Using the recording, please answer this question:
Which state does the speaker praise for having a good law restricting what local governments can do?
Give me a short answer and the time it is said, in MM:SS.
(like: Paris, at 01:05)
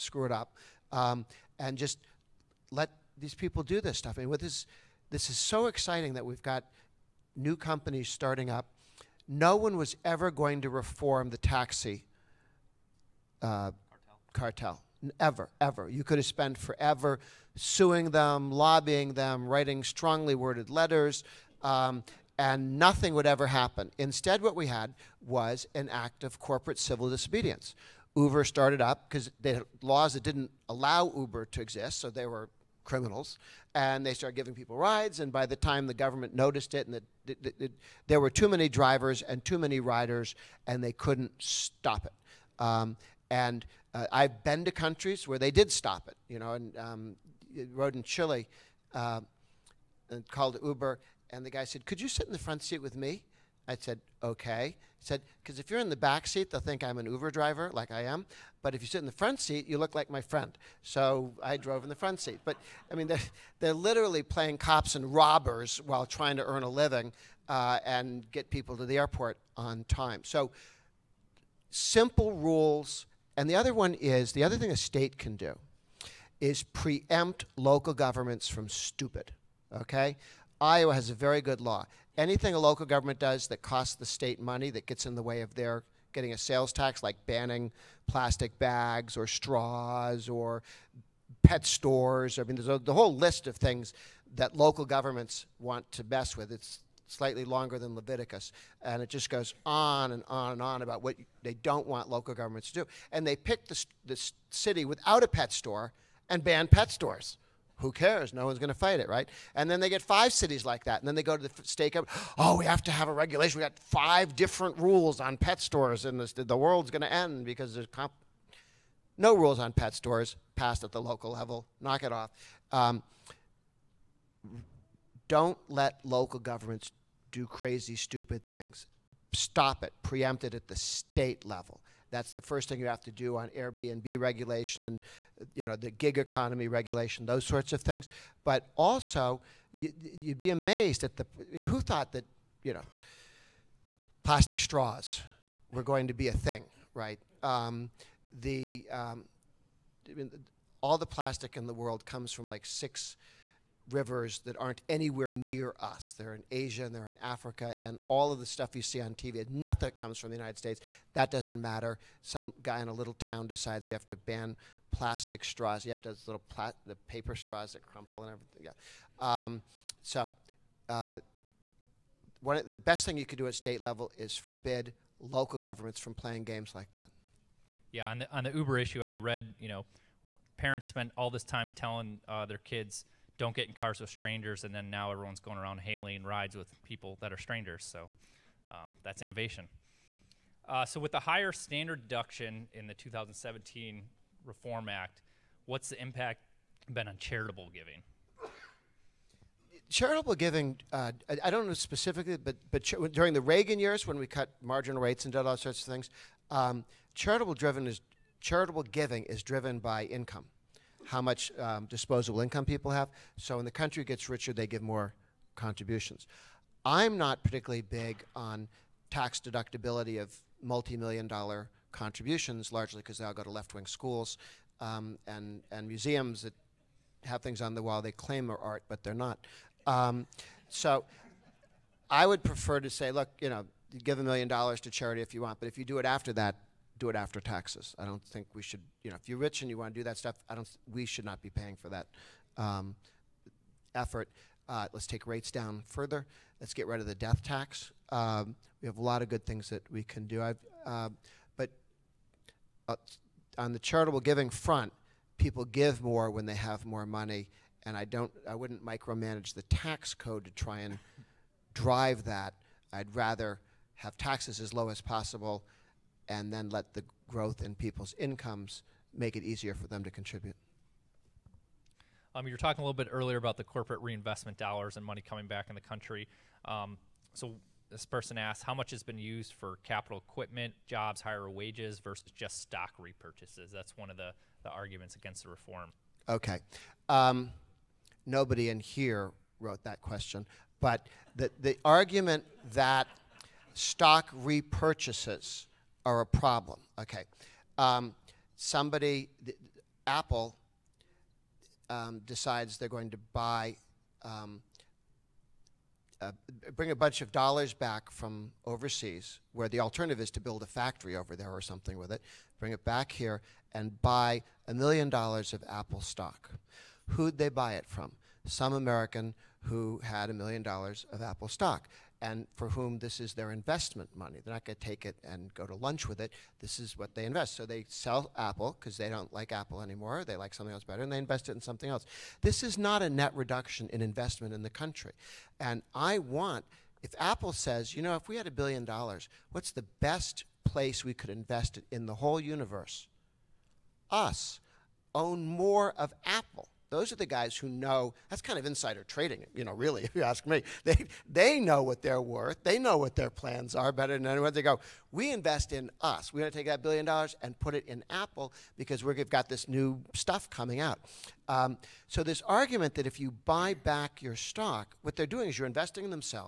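Iowa, at 01:20.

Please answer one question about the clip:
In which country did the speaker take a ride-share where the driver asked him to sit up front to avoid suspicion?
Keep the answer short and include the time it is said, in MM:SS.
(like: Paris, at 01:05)
Chile, at 00:48.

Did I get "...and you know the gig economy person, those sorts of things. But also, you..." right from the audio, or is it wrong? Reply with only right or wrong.
wrong.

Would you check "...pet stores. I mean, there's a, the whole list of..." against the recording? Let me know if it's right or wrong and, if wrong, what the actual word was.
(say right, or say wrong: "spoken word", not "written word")
right.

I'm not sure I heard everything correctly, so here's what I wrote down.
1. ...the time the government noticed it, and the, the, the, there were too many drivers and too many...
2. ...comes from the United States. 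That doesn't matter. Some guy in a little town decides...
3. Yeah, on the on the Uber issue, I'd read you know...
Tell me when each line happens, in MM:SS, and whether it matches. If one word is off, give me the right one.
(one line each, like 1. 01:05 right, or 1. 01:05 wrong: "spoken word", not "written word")
1. 00:35 right
2. 02:39 right
3. 02:57 right.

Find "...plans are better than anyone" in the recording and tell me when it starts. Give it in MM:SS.
05:53.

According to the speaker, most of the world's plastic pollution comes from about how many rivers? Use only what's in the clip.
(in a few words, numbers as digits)
6.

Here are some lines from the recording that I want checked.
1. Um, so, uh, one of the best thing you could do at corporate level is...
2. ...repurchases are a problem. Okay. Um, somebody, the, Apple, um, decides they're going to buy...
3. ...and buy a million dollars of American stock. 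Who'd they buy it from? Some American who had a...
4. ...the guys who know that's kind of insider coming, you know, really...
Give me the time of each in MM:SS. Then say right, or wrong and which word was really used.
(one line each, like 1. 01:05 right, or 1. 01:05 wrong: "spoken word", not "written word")
1. 02:49 wrong: "state", not "corporate"
2. 04:54 right
3. 05:13 wrong: "Apple", not "American"
4. 05:47 wrong: "trading", not "coming".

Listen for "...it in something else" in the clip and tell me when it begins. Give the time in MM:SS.
05:31.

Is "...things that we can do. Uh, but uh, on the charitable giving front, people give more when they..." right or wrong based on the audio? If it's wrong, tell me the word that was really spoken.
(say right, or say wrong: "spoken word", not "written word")
right.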